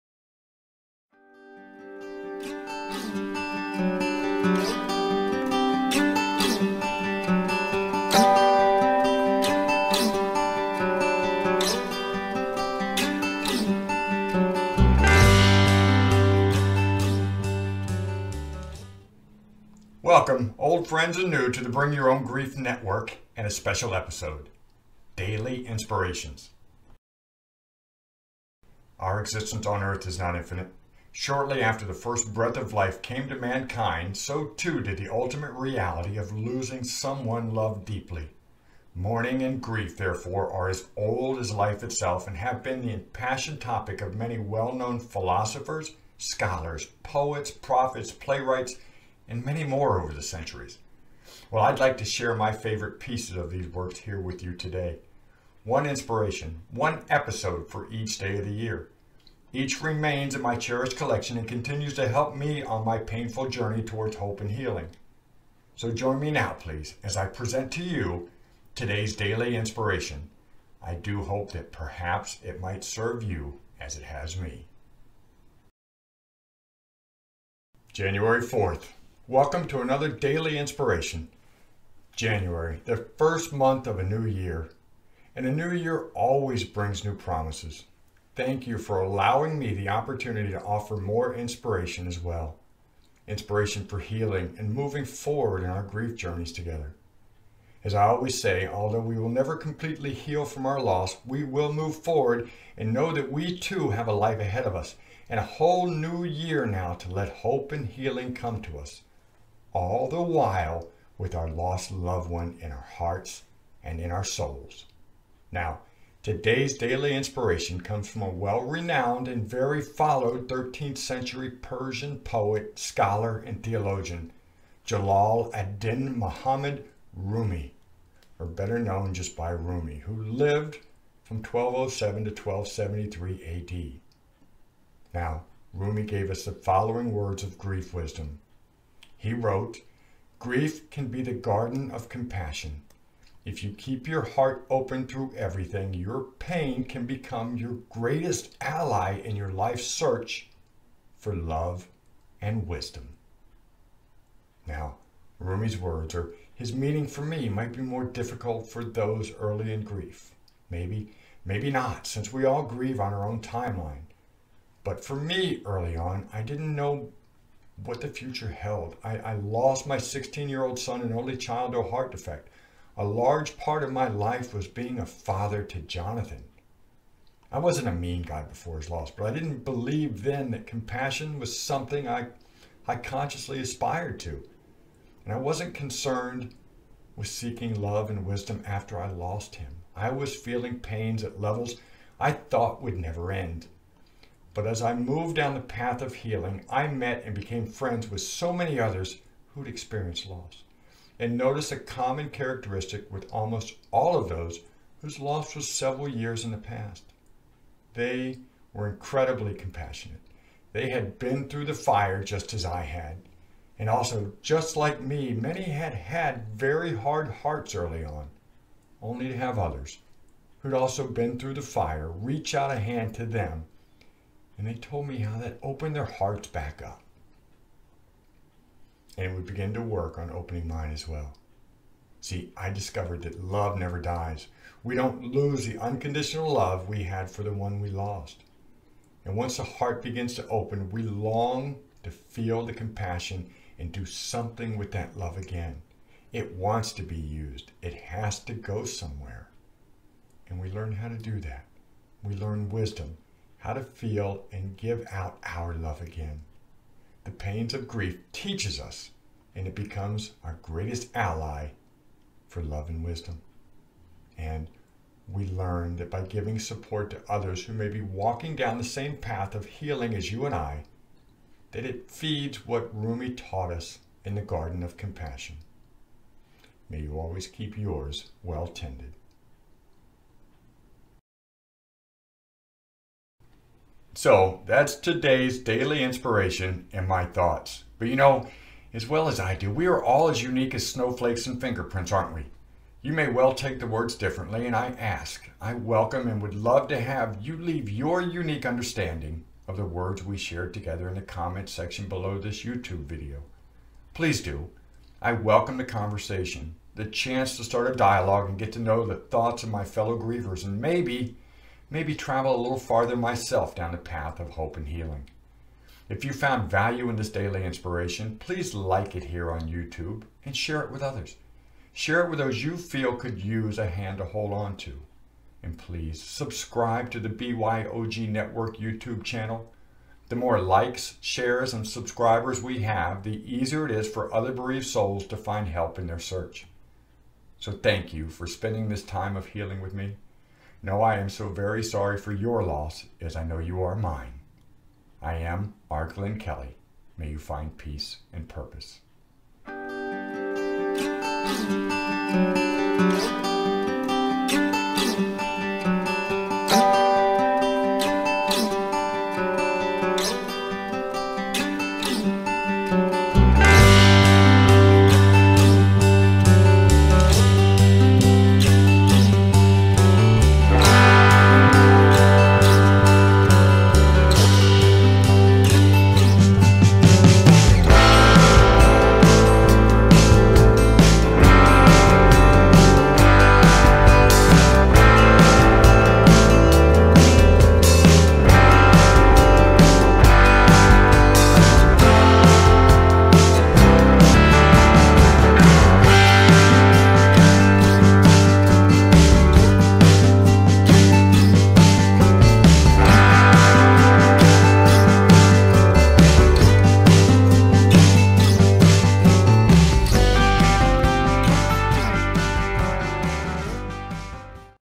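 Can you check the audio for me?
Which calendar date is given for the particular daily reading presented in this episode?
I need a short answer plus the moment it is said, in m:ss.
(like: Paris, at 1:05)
January 4th, at 1:17.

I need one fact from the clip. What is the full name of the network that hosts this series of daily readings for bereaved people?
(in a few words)
Bring Your Own Grief Network.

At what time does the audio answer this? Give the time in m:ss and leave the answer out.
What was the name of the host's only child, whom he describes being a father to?
2:55.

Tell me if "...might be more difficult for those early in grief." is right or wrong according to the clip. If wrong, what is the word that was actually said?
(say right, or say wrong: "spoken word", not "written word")
right.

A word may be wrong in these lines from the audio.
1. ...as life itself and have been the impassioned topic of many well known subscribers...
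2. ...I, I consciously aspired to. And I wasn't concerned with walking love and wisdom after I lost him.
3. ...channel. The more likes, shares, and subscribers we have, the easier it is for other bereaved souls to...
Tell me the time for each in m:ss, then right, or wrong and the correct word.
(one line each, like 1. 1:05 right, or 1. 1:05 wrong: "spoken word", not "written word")
1. 0:41 wrong: "philosophers", not "subscribers"
2. 3:02 wrong: "seeking", not "walking"
3. 5:29 right.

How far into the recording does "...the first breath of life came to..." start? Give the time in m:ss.
0:31.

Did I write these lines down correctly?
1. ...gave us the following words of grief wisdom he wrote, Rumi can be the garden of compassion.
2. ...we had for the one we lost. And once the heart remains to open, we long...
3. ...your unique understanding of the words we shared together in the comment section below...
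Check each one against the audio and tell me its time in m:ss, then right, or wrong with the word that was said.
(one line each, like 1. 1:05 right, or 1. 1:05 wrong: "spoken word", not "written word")
1. 2:16 wrong: "Grief", not "Rumi"
2. 3:56 wrong: "begins", not "remains"
3. 4:57 right.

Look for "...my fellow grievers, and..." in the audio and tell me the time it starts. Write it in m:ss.
5:09.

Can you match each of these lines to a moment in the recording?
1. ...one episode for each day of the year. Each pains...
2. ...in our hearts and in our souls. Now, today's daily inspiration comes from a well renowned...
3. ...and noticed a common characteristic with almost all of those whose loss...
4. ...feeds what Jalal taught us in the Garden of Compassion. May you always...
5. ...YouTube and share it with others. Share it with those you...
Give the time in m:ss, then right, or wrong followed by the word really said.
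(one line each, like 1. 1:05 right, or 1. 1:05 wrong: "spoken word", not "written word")
1. 0:56 wrong: "remains", not "pains"
2. 1:52 right
3. 3:21 right
4. 4:32 wrong: "Rumi", not "Jalal"
5. 5:19 right.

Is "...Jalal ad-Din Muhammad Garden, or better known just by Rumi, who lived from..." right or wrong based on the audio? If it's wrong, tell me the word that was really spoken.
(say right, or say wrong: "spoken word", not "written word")
wrong: "Rumi", not "Garden".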